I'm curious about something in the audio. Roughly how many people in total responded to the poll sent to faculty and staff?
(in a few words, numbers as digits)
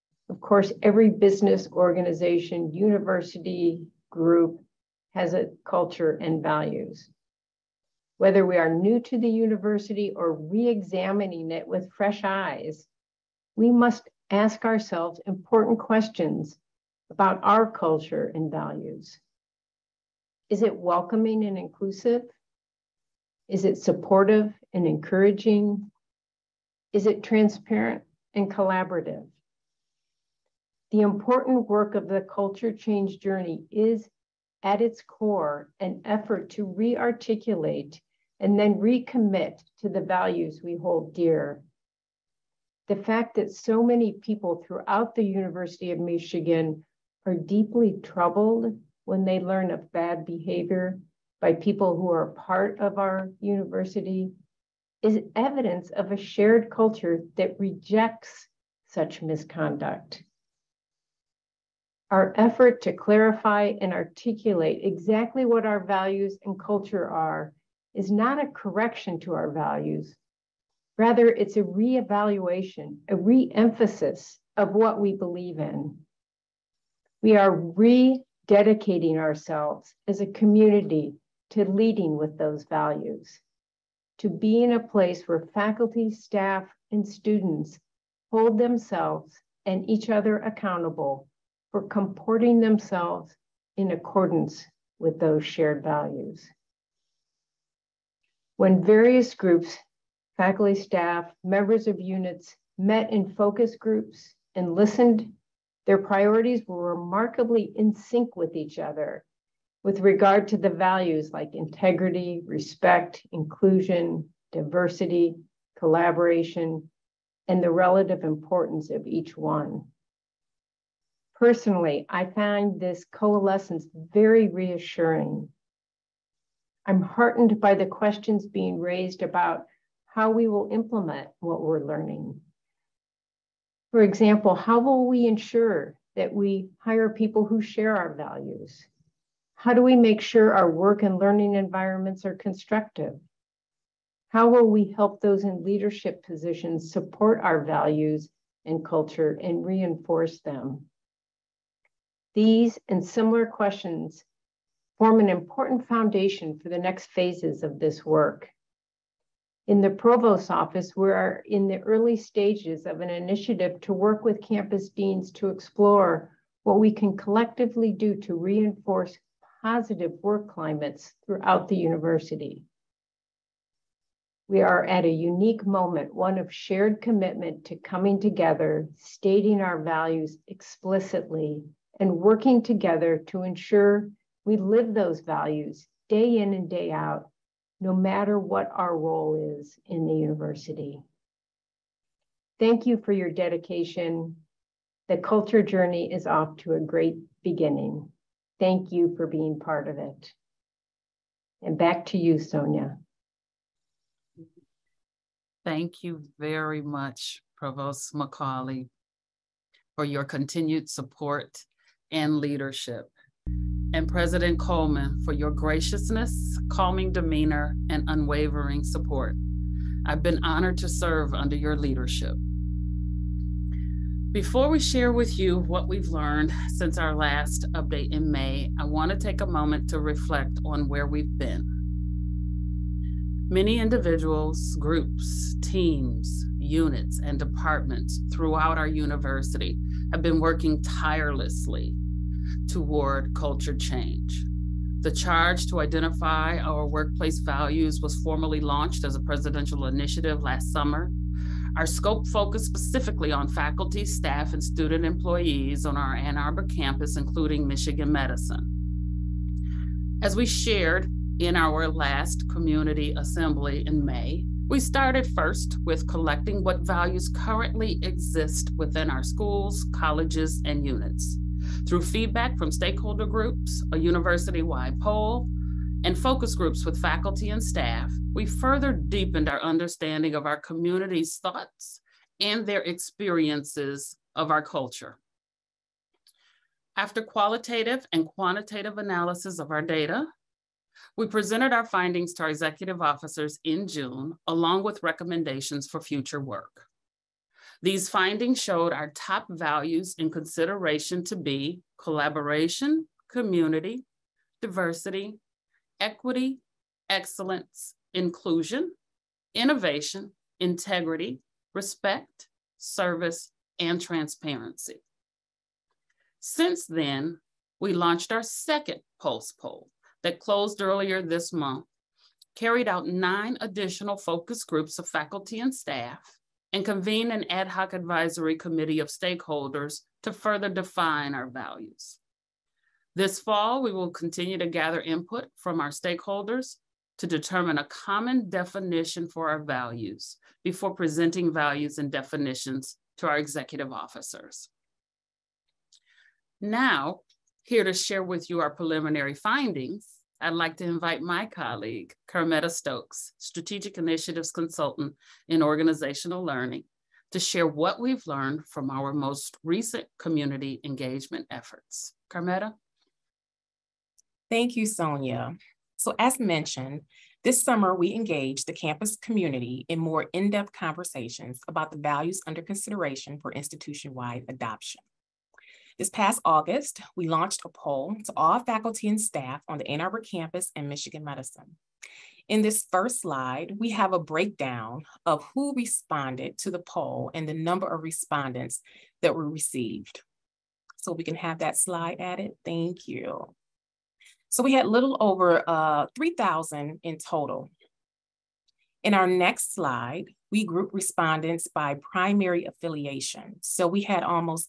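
3,000.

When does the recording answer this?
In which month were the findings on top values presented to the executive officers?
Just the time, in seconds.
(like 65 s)
293 s.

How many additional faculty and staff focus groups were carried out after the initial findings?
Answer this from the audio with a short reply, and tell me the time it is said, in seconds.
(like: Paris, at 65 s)
9, at 323 s.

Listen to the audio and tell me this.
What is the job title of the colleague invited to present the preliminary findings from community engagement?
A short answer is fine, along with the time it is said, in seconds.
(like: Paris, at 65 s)
Strategic Initiatives Consultant, at 353 s.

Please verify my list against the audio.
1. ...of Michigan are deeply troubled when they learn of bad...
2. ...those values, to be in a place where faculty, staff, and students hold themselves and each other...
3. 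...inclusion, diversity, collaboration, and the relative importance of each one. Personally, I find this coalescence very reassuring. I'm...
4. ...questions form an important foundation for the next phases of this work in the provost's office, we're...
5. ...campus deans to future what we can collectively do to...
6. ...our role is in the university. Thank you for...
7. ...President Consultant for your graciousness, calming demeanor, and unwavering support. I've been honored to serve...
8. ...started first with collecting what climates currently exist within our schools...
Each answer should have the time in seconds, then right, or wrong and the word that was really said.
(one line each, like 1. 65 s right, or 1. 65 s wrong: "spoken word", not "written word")
1. 45 s right
2. 82 s right
3. 113 s right
4. 153 s right
5. 164 s wrong: "explore", not "future"
6. 188 s right
7. 214 s wrong: "Coleman", not "Consultant"
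8. 264 s wrong: "values", not "climates".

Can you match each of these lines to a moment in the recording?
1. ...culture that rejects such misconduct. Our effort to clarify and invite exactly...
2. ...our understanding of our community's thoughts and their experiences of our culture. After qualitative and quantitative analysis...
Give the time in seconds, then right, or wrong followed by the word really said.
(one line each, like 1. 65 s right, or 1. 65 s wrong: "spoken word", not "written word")
1. 56 s wrong: "articulate", not "invite"
2. 279 s right.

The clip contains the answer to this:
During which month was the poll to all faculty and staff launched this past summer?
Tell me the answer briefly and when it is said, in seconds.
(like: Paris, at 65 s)
August, at 376 s.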